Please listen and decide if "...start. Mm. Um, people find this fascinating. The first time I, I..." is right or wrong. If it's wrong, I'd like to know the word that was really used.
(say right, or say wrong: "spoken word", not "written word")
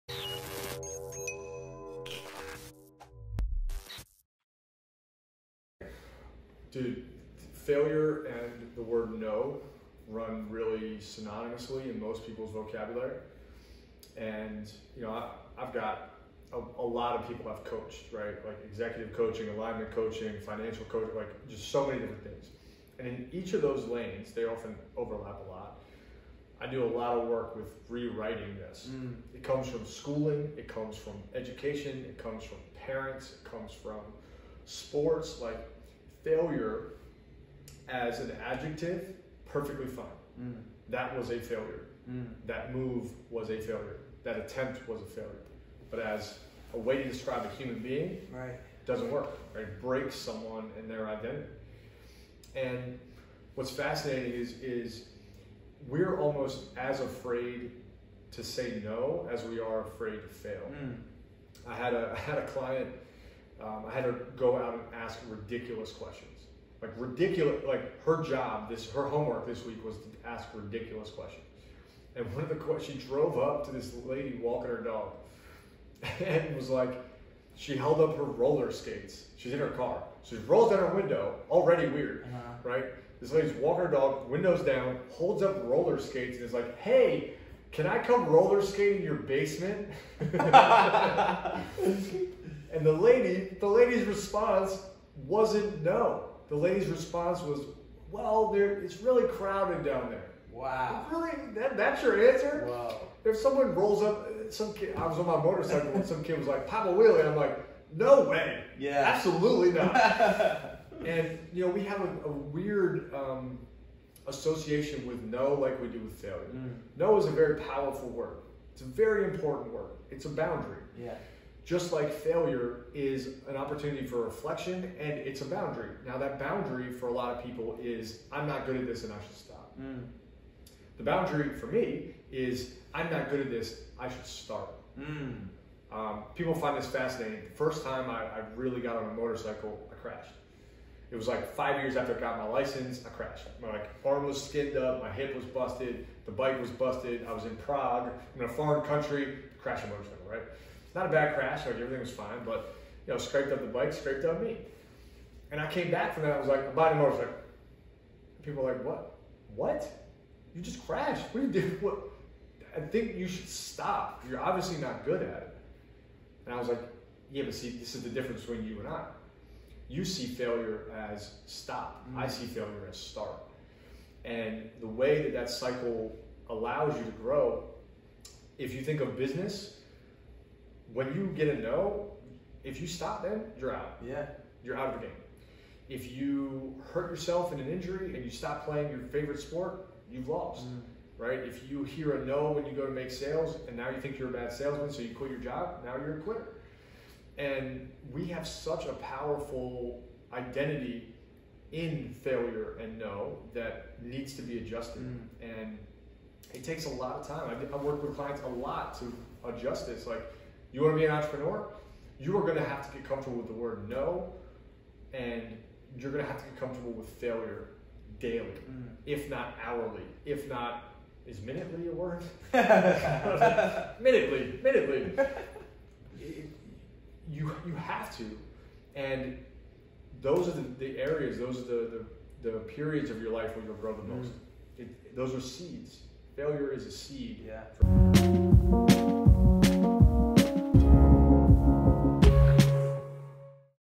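right.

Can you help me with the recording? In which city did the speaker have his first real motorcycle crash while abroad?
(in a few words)
Prague.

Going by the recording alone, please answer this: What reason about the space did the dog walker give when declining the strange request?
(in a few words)
it's really crowded.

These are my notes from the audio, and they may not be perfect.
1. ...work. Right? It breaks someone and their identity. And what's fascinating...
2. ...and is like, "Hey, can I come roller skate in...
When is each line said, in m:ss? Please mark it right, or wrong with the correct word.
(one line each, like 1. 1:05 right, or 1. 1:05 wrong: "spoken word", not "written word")
1. 0:49 right
2. 1:26 right.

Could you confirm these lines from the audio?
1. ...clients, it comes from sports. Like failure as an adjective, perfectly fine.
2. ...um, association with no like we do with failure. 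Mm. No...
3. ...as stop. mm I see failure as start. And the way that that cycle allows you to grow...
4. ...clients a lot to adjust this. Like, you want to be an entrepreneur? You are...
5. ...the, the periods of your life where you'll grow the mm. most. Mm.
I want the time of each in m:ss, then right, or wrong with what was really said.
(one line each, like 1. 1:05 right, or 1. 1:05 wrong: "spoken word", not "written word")
1. 0:32 wrong: "parents", not "clients"
2. 1:53 right
3. 2:51 right
4. 3:28 right
5. 3:52 right.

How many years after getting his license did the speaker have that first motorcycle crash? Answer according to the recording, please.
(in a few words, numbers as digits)
5.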